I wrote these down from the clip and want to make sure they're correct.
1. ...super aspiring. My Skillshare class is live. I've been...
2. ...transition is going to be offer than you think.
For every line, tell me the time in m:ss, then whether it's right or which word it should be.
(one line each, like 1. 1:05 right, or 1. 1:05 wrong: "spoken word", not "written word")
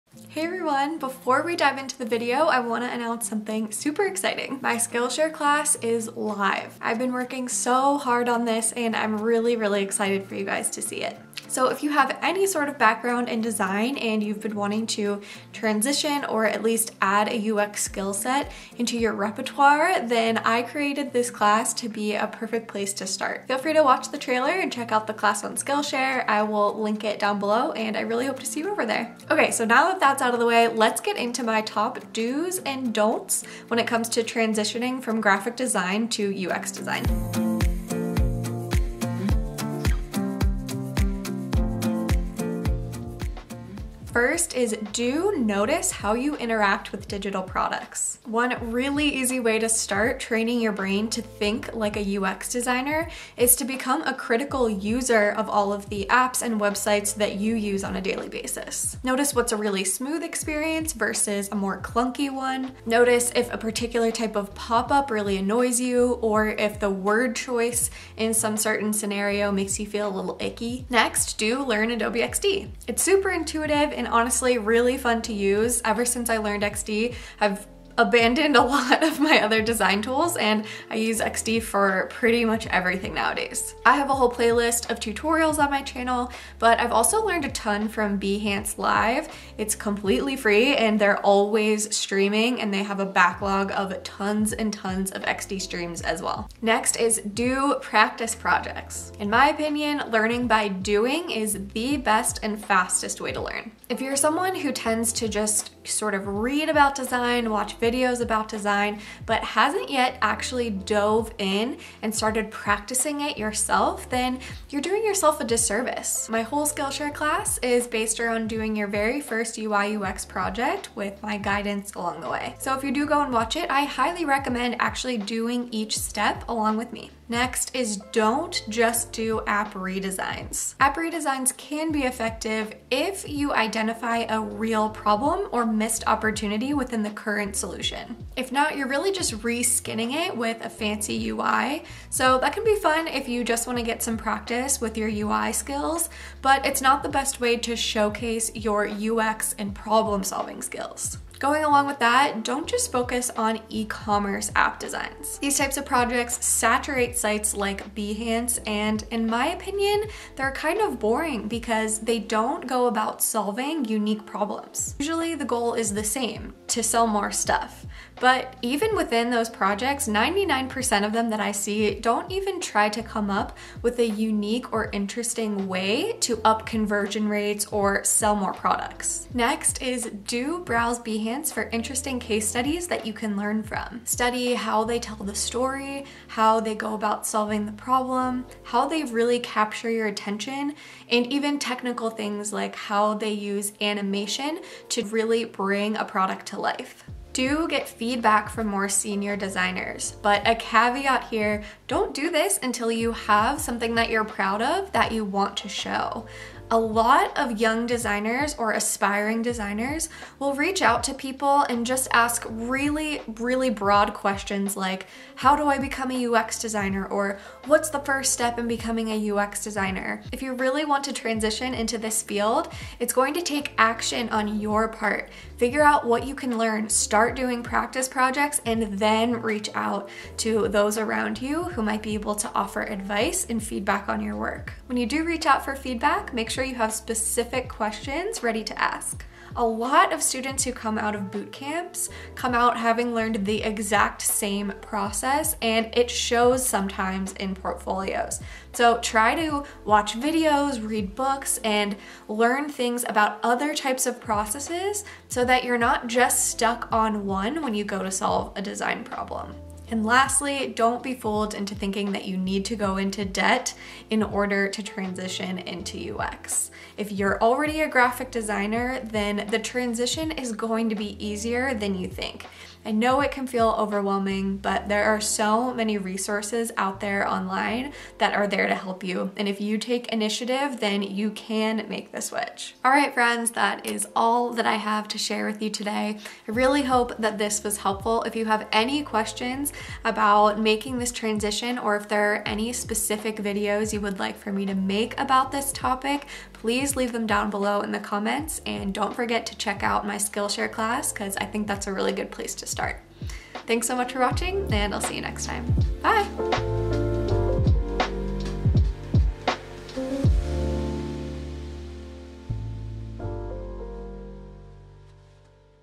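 1. 0:03 wrong: "exciting", not "aspiring"
2. 4:29 wrong: "easier", not "offer".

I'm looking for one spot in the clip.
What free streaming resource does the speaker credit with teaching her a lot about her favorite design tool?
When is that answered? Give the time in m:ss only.
1:28.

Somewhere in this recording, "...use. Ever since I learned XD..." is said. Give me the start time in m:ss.
1:15.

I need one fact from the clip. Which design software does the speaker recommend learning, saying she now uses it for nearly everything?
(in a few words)
Adobe XD.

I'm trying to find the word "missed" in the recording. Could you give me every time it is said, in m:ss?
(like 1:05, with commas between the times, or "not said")
2:15.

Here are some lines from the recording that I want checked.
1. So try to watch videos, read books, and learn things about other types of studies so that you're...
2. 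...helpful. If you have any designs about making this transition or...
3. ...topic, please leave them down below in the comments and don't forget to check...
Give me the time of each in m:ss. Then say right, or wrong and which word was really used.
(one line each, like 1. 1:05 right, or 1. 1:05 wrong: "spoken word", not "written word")
1. 4:08 wrong: "processes", not "studies"
2. 4:47 wrong: "questions", not "designs"
3. 4:55 right.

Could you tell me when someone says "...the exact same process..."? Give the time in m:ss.
4:03.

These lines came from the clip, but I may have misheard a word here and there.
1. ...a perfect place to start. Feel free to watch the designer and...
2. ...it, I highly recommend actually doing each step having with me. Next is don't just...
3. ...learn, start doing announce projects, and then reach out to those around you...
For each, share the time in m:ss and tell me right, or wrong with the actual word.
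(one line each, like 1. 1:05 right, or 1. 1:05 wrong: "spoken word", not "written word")
1. 0:22 wrong: "trailer", not "designer"
2. 2:03 wrong: "along", not "having"
3. 3:46 wrong: "practice", not "announce".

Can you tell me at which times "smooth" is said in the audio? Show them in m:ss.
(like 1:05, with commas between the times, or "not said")
0:59.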